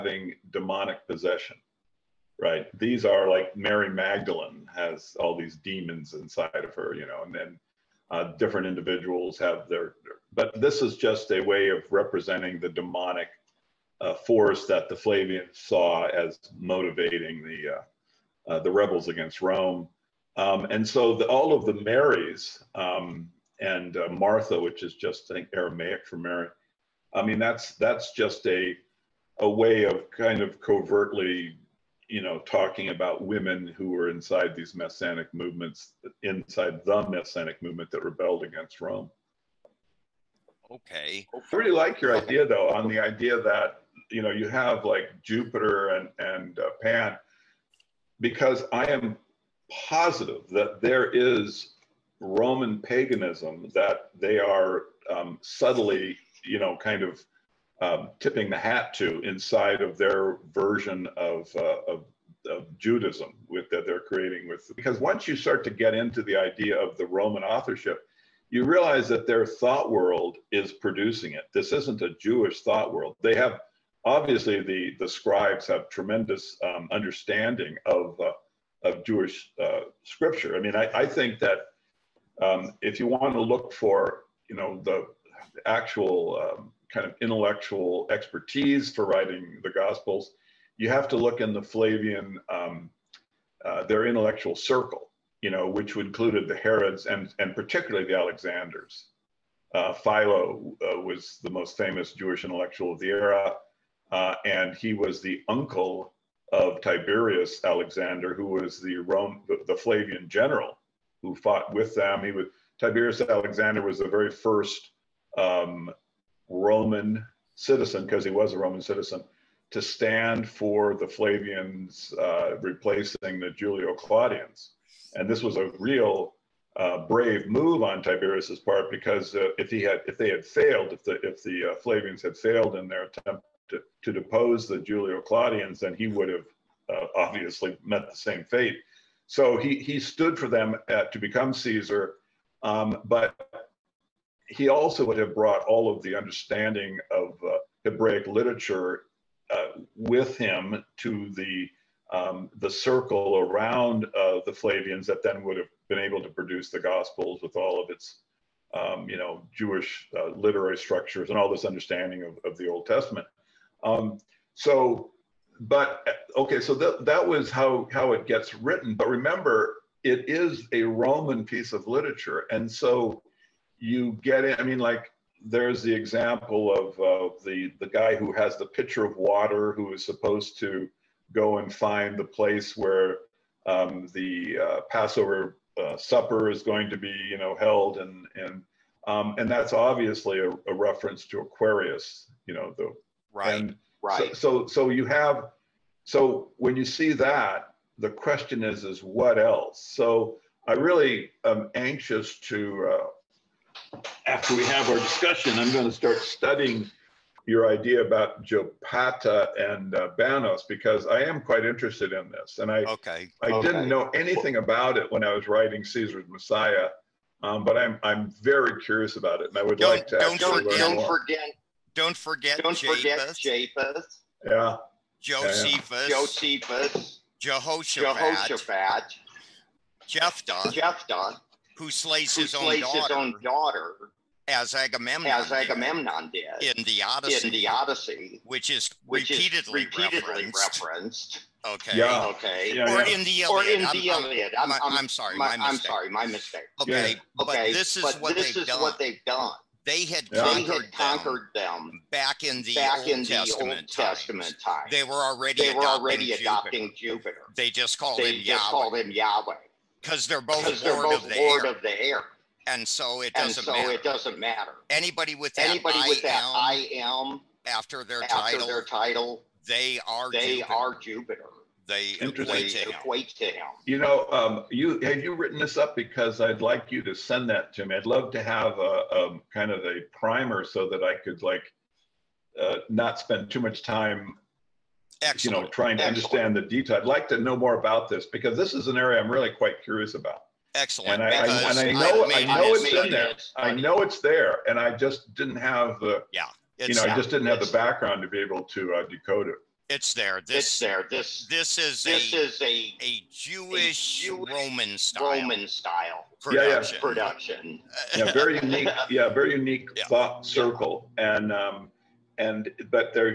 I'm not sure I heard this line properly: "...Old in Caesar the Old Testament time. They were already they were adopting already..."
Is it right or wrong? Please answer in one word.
wrong.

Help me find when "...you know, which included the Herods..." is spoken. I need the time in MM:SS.
01:35.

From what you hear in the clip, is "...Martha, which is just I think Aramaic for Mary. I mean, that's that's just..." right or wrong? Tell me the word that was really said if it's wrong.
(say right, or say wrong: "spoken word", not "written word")
right.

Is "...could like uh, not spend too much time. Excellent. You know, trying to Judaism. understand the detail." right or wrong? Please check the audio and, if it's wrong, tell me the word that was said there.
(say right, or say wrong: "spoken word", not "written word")
wrong: "Excellent", not "Judaism".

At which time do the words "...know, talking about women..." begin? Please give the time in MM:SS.
00:32.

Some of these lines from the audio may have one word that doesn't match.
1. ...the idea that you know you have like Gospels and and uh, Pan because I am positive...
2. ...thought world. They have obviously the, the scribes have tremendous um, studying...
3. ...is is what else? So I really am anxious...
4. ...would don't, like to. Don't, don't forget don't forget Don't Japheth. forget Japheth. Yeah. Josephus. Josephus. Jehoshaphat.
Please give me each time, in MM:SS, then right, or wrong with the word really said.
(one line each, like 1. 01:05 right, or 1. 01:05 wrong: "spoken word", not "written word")
1. 00:42 wrong: "Jupiter", not "Gospels"
2. 01:12 wrong: "understanding", not "studying"
3. 03:18 right
4. 03:39 right.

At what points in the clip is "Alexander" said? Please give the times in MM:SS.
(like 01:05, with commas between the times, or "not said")
01:38, 01:47, 01:53.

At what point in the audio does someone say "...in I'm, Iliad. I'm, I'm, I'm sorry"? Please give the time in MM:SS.
04:03.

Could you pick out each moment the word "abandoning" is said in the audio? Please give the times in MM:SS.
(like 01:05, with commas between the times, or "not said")
not said.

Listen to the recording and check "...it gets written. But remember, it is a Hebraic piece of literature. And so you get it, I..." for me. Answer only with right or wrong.
wrong.